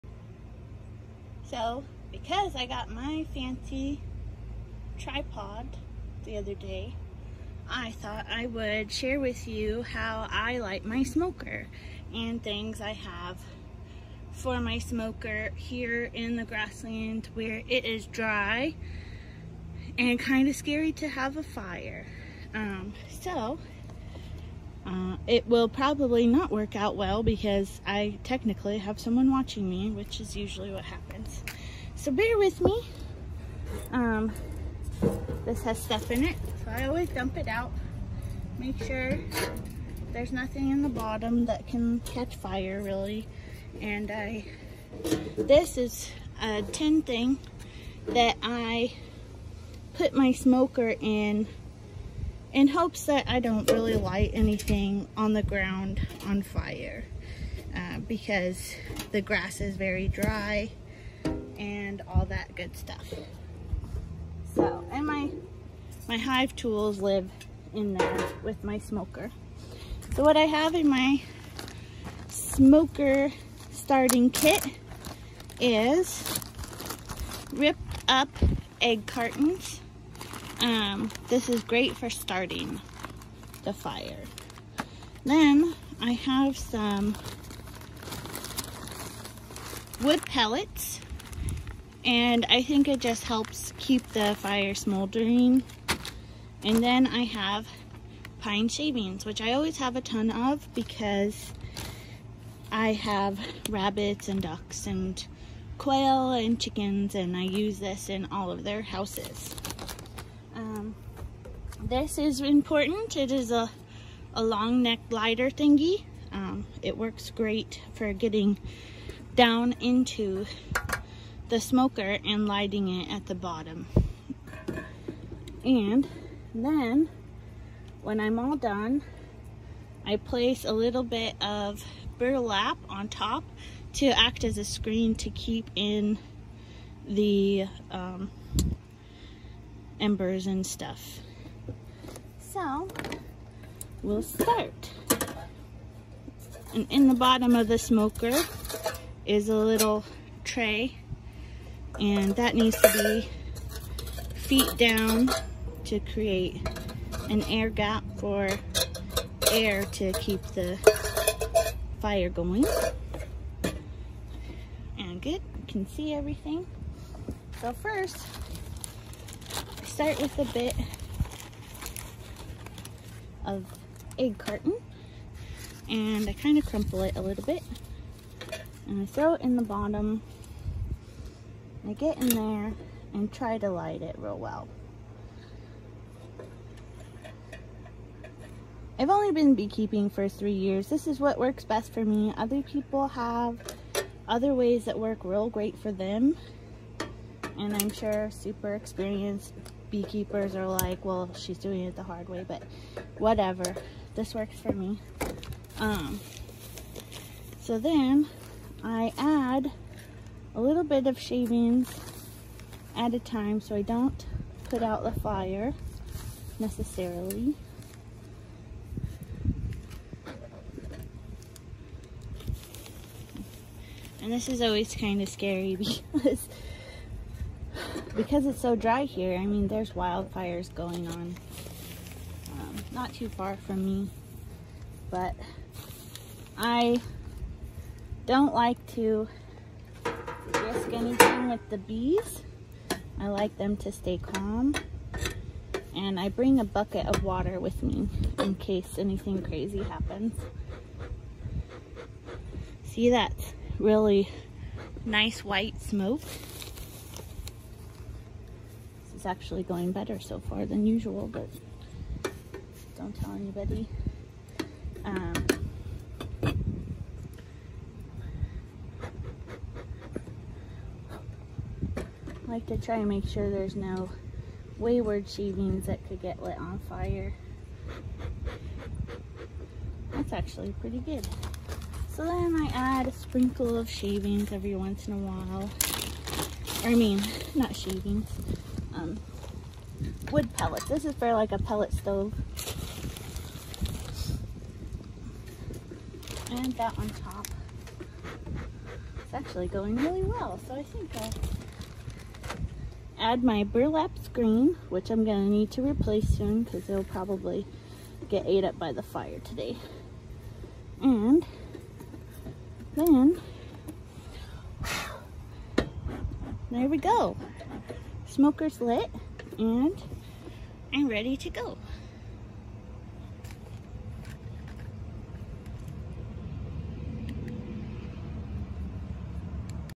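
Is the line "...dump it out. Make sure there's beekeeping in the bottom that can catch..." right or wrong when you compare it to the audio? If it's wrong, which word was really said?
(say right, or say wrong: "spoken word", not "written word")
wrong: "nothing", not "beekeeping".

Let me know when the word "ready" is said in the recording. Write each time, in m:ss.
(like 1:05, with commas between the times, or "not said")
5:21.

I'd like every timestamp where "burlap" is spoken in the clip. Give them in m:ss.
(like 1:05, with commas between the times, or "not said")
2:12, 5:03.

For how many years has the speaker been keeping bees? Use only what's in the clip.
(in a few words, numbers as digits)
3.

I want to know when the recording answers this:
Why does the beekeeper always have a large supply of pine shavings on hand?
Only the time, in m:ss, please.
1:43.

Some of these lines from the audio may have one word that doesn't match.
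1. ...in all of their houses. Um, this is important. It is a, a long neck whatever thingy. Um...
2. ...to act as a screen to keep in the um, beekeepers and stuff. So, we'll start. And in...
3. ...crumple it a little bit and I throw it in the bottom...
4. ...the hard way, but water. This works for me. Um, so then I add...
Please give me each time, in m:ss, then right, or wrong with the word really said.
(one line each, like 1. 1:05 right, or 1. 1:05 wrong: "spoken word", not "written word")
1. 1:48 wrong: "lighter", not "whatever"
2. 2:13 wrong: "embers", not "beekeepers"
3. 2:56 right
4. 3:21 wrong: "whatever", not "water".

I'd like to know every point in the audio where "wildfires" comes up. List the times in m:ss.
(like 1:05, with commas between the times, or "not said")
3:49.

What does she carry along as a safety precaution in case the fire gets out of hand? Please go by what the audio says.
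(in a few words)
A bucket of water.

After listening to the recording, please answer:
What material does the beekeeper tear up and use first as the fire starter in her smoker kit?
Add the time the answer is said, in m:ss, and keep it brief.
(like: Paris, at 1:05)
Egg cartons, at 1:18.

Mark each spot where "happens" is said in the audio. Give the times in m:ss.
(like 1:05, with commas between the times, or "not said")
0:30, 4:09.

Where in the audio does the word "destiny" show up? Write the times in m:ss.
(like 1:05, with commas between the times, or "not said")
not said.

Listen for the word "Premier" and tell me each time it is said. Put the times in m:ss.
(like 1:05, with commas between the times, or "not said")
not said.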